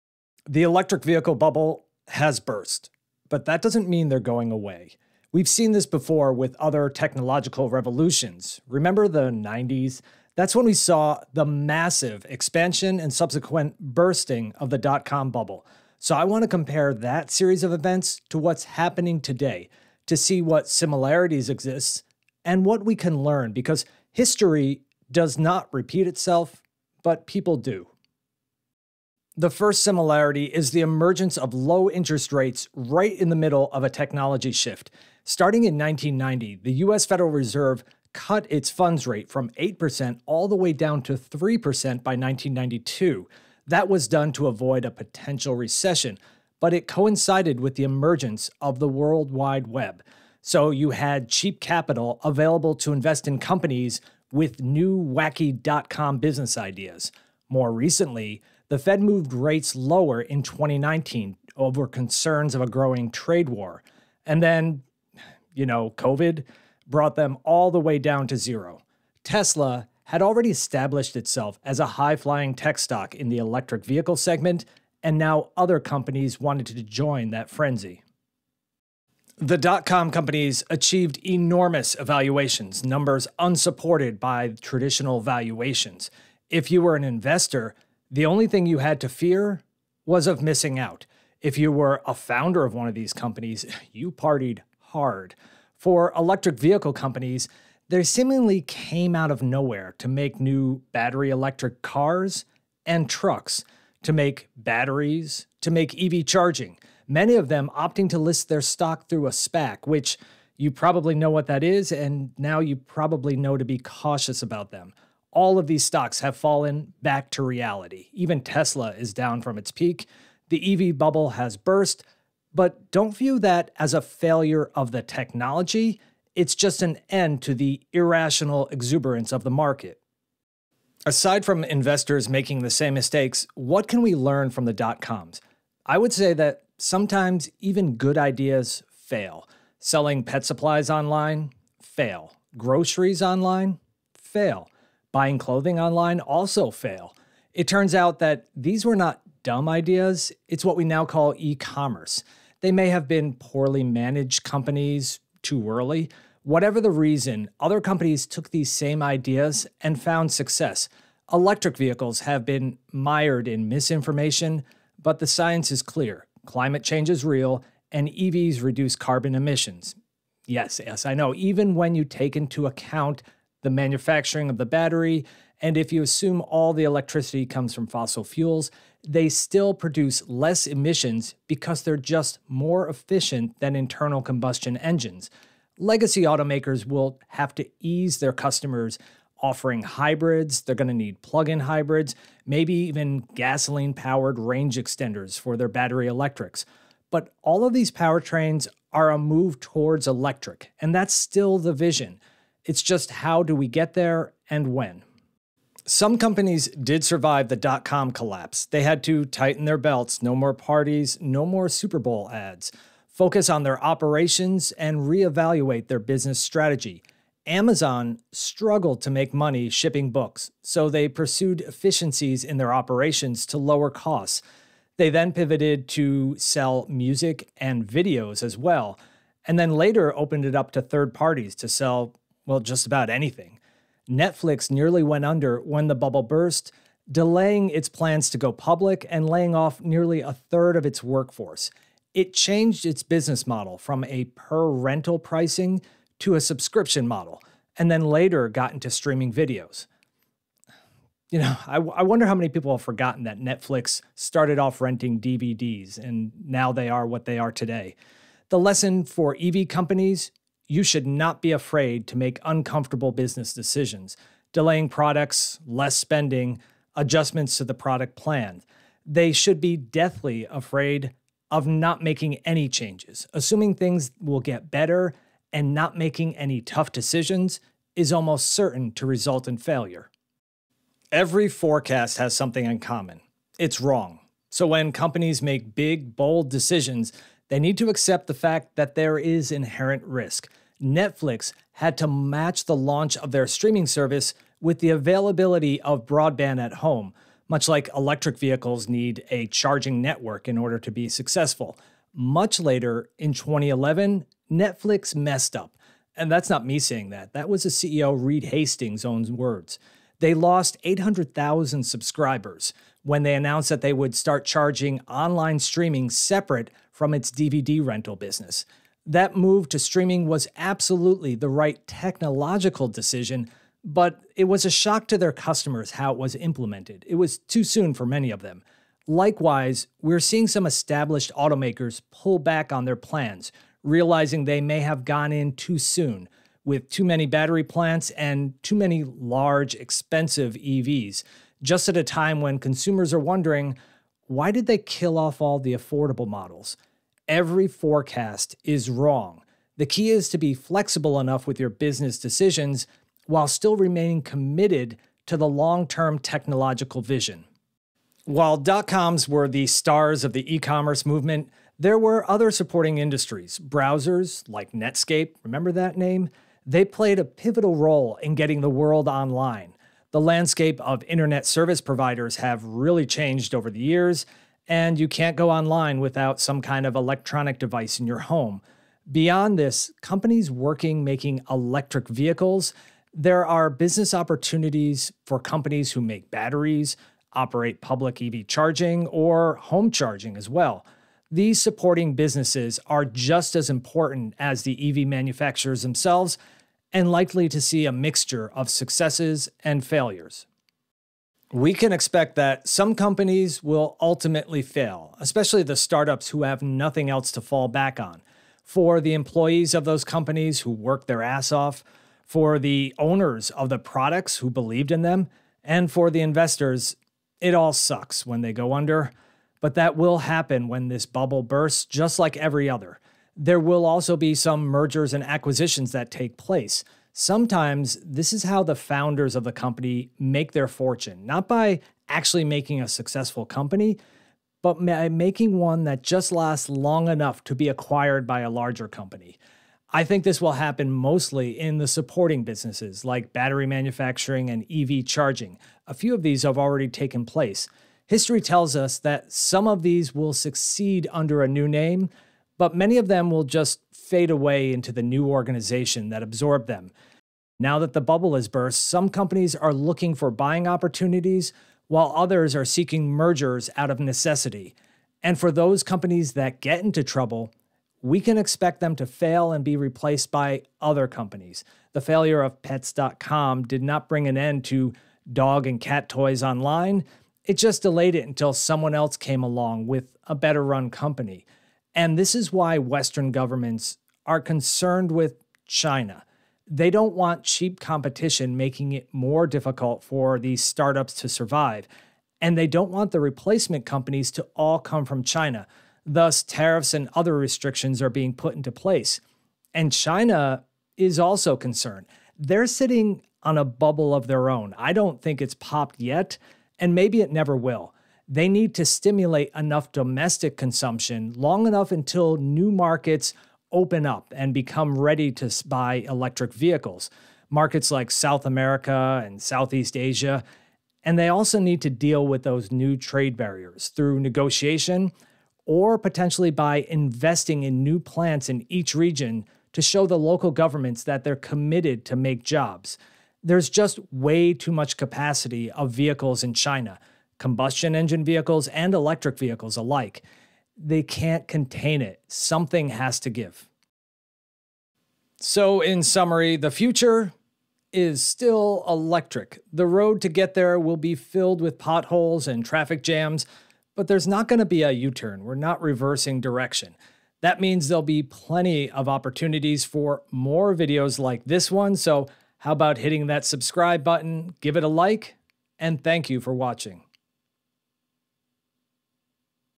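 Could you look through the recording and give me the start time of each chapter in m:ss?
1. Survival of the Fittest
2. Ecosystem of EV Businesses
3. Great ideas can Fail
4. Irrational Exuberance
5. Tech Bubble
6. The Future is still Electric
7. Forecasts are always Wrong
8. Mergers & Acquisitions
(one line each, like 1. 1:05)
1. 3:26
2. 5:58
3. 2:11
4. 1:21
5. 0:30
6. 9:04
7. 4:41
8. 6:40.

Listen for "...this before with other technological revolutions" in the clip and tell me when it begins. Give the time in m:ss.
0:05.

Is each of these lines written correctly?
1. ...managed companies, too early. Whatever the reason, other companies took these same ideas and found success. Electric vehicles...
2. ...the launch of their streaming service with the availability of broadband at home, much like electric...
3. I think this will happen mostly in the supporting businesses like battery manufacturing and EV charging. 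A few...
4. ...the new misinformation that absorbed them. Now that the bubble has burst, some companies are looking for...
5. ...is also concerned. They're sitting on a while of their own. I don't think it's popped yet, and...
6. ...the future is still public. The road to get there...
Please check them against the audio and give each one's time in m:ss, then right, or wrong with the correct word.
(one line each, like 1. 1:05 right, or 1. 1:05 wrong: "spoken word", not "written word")
1. 2:33 right
2. 4:52 right
3. 7:19 right
4. 7:34 wrong: "organization", not "misinformation"
5. 8:20 wrong: "bubble", not "while"
6. 9:06 wrong: "electric", not "public".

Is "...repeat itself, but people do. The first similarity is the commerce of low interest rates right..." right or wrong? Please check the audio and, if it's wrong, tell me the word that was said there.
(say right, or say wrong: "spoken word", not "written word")
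wrong: "emergence", not "commerce".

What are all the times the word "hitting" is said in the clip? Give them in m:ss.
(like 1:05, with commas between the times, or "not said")
9:22.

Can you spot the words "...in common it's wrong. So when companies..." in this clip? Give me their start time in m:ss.
4:42.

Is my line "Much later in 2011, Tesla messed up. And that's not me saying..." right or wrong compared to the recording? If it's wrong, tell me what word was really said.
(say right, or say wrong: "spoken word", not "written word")
wrong: "Netflix", not "Tesla".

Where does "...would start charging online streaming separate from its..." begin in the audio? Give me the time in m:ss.
5:13.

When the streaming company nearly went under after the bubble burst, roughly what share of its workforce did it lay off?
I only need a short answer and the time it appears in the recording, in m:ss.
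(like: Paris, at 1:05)
a third, at 4:00.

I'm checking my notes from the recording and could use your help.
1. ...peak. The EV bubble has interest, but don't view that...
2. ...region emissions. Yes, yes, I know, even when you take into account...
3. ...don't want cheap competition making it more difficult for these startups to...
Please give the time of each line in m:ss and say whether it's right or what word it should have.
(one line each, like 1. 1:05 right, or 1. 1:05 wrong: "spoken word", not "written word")
1. 1:59 wrong: "burst", not "interest"
2. 2:48 wrong: "carbon", not "region"
3. 8:06 right.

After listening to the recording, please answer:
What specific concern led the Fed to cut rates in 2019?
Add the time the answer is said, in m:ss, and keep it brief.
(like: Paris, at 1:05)
a growing trade war, at 1:02.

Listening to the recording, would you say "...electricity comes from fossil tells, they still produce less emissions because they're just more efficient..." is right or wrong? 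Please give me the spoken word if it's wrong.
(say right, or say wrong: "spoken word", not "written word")
wrong: "fuels", not "tells".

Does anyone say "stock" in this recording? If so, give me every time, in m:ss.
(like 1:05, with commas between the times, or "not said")
1:12, 1:48, 1:55.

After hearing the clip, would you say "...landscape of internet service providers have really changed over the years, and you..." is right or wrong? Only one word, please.
right.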